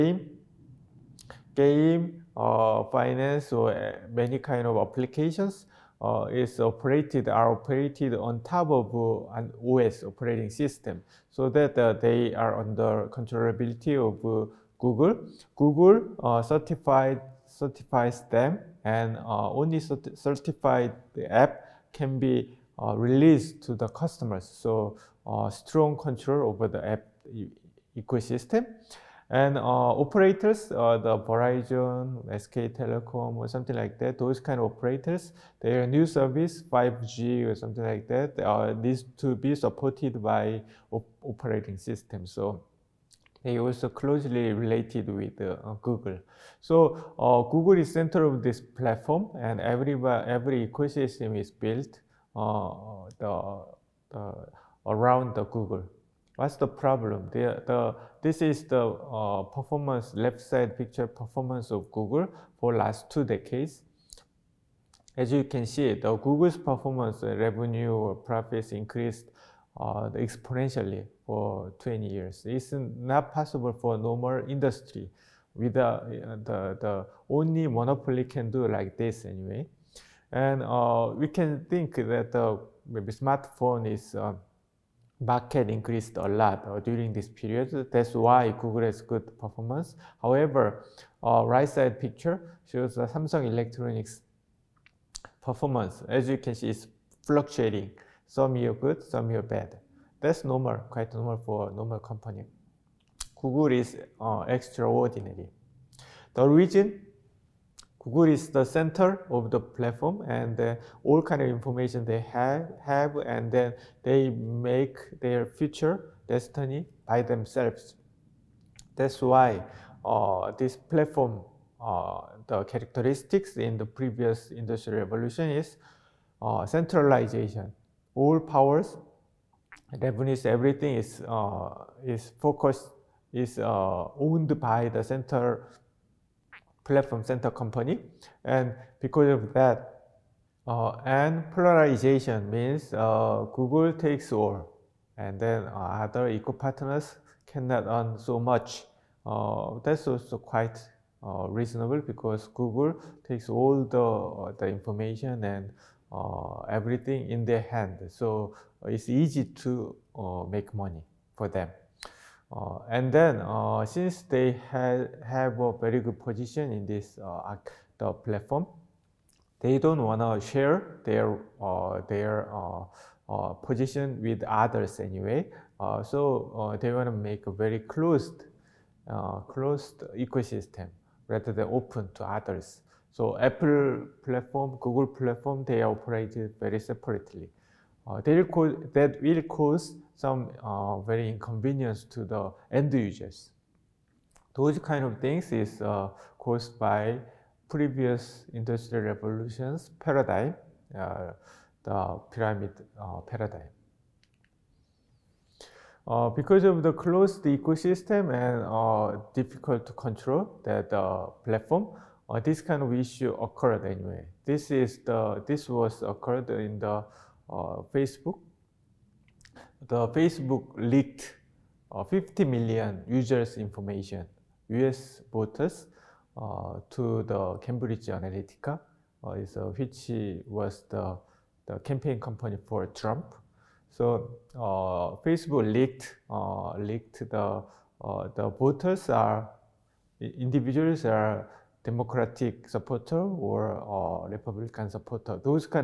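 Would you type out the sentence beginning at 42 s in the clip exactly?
So they also closely related with uh, Google.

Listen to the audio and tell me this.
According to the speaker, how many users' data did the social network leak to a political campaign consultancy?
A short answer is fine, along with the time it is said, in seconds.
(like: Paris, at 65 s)
50 million, at 222 s.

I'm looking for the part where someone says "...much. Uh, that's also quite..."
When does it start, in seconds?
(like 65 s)
148 s.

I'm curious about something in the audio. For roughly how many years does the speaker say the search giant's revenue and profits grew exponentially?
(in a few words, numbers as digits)
20 years.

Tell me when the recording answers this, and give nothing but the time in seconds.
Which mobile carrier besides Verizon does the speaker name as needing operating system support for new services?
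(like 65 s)
32 s.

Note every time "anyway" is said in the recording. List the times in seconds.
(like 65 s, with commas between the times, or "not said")
79 s, 175 s, 213 s.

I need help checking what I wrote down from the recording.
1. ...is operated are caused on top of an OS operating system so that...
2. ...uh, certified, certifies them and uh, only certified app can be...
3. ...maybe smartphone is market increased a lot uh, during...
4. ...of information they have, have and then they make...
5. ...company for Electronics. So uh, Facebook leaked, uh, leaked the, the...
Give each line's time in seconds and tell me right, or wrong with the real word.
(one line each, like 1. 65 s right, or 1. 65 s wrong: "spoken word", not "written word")
1. 6 s wrong: "operated", not "caused"
2. 16 s right
3. 82 s right
4. 111 s right
5. 232 s wrong: "Trump", not "Electronics".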